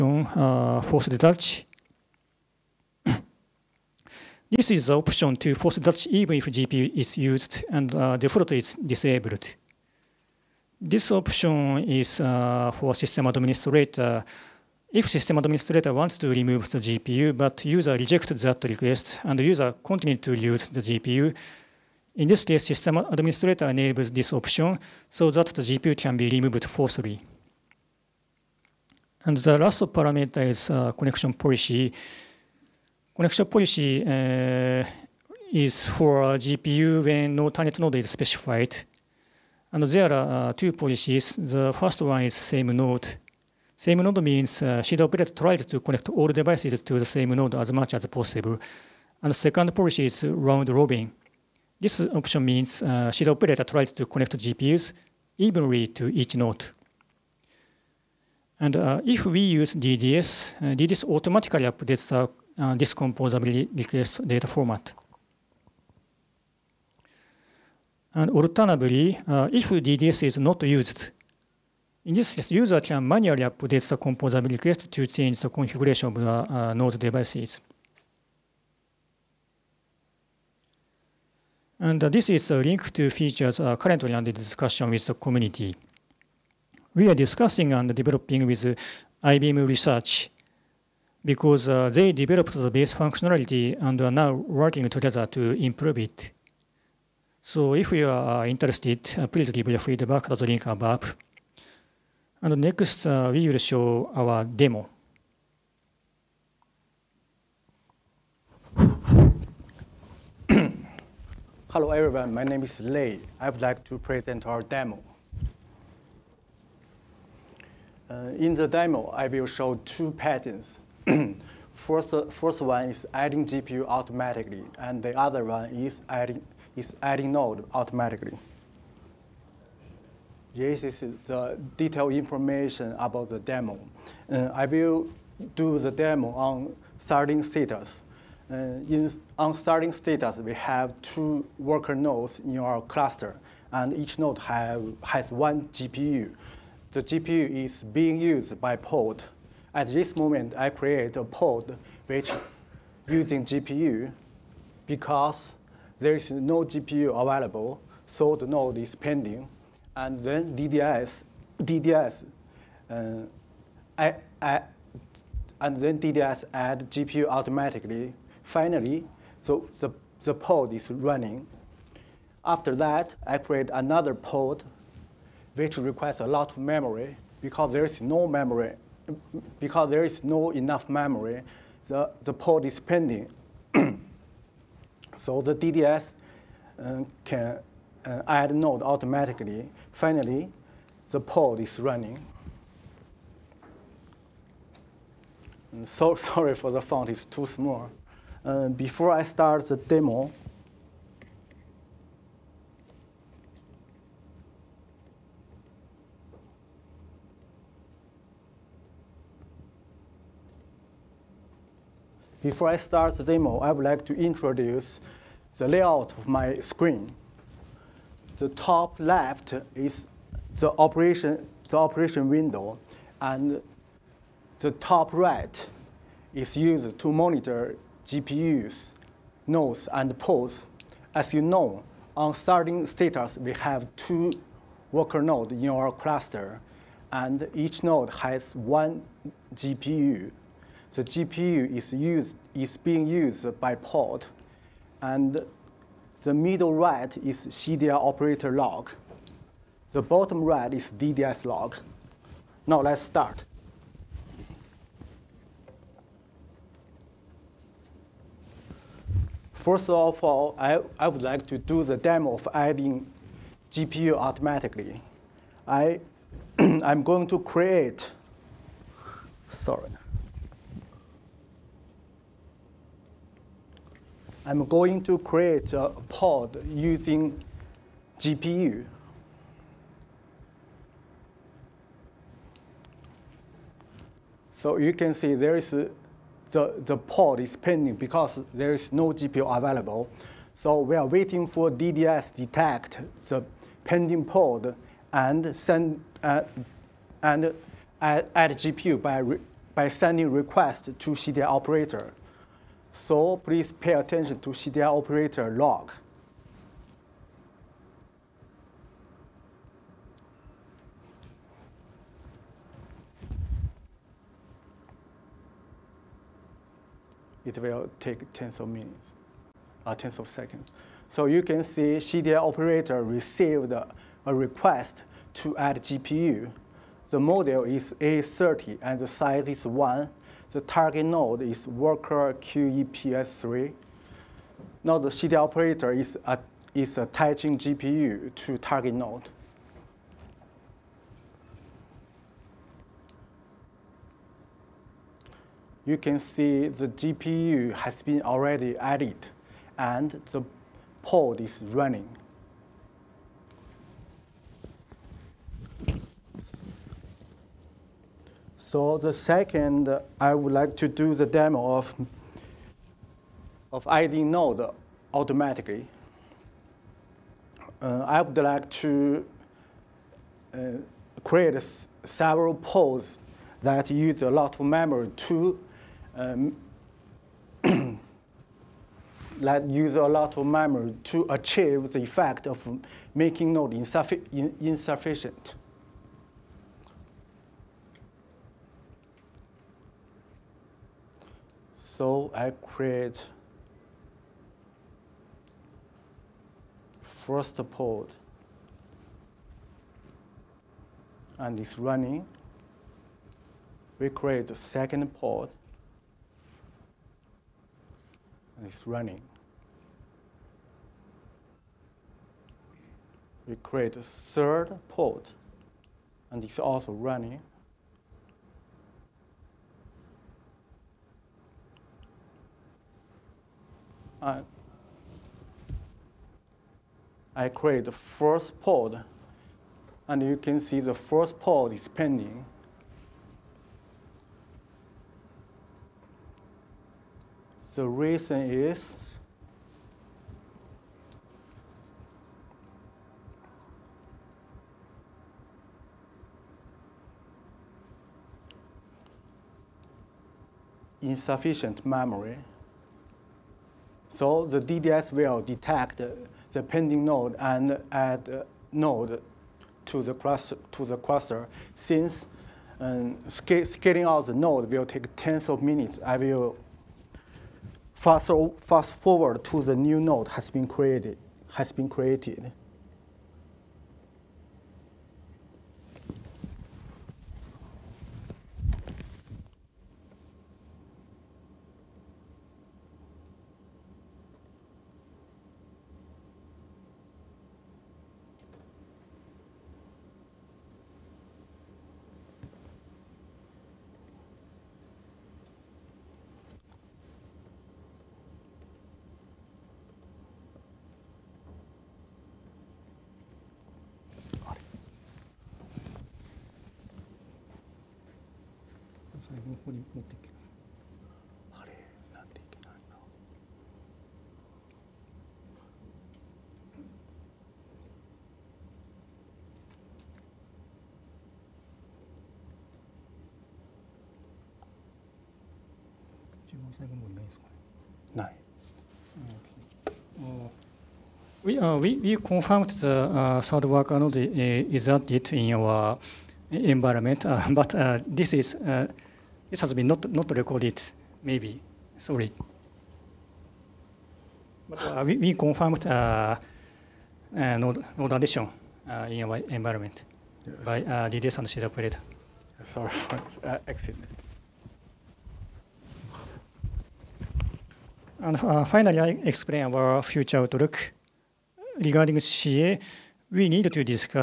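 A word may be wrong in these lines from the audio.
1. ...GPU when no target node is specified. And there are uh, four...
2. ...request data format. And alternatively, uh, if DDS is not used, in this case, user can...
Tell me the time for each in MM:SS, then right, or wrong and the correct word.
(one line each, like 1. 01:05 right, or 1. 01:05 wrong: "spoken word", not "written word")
1. 00:36 wrong: "two", not "four"
2. 01:03 right.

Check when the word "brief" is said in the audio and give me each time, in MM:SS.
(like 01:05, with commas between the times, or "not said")
not said.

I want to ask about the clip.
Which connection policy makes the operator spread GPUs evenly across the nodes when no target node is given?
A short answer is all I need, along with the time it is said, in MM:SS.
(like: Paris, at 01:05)
Round robin, at 00:50.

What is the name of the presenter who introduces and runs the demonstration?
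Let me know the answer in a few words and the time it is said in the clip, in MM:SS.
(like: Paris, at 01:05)
Lei, at 01:52.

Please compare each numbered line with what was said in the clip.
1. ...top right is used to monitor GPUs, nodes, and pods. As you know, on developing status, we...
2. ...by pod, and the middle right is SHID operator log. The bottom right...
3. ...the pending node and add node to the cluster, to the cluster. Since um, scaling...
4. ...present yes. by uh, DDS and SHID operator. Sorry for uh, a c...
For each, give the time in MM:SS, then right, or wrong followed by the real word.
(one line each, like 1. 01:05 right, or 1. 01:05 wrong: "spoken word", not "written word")
1. 03:44 wrong: "starting", not "developing"
2. 04:03 wrong: "CDI", not "SHID"
3. 07:36 right
4. 09:09 wrong: "environment", not "present".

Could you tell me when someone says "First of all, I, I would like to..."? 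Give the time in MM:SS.
04:19.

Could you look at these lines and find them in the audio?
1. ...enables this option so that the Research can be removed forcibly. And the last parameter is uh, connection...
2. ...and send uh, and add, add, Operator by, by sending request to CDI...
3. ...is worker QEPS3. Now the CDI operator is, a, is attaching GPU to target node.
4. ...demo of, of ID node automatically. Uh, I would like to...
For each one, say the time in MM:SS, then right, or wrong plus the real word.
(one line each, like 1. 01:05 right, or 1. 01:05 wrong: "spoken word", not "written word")
1. 00:23 wrong: "GPU", not "Research"
2. 04:55 wrong: "GPU", not "Operator"
3. 05:31 right
4. 06:01 right.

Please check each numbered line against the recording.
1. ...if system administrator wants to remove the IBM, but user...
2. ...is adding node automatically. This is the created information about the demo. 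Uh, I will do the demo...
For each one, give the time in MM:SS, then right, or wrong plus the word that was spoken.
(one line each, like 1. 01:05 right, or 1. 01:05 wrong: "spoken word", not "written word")
1. 00:14 wrong: "GPU", not "IBM"
2. 02:06 wrong: "detailed", not "created".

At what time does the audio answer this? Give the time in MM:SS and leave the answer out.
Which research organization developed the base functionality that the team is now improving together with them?
01:29.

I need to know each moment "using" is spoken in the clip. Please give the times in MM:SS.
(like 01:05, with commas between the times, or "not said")
02:33, 04:36.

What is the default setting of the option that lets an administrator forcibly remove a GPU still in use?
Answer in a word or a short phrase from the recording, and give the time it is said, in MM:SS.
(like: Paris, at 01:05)
Disabled, at 00:08.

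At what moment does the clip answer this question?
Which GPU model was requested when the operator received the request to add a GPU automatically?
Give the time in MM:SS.
05:27.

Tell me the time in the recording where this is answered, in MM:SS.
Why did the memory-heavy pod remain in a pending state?
07:30.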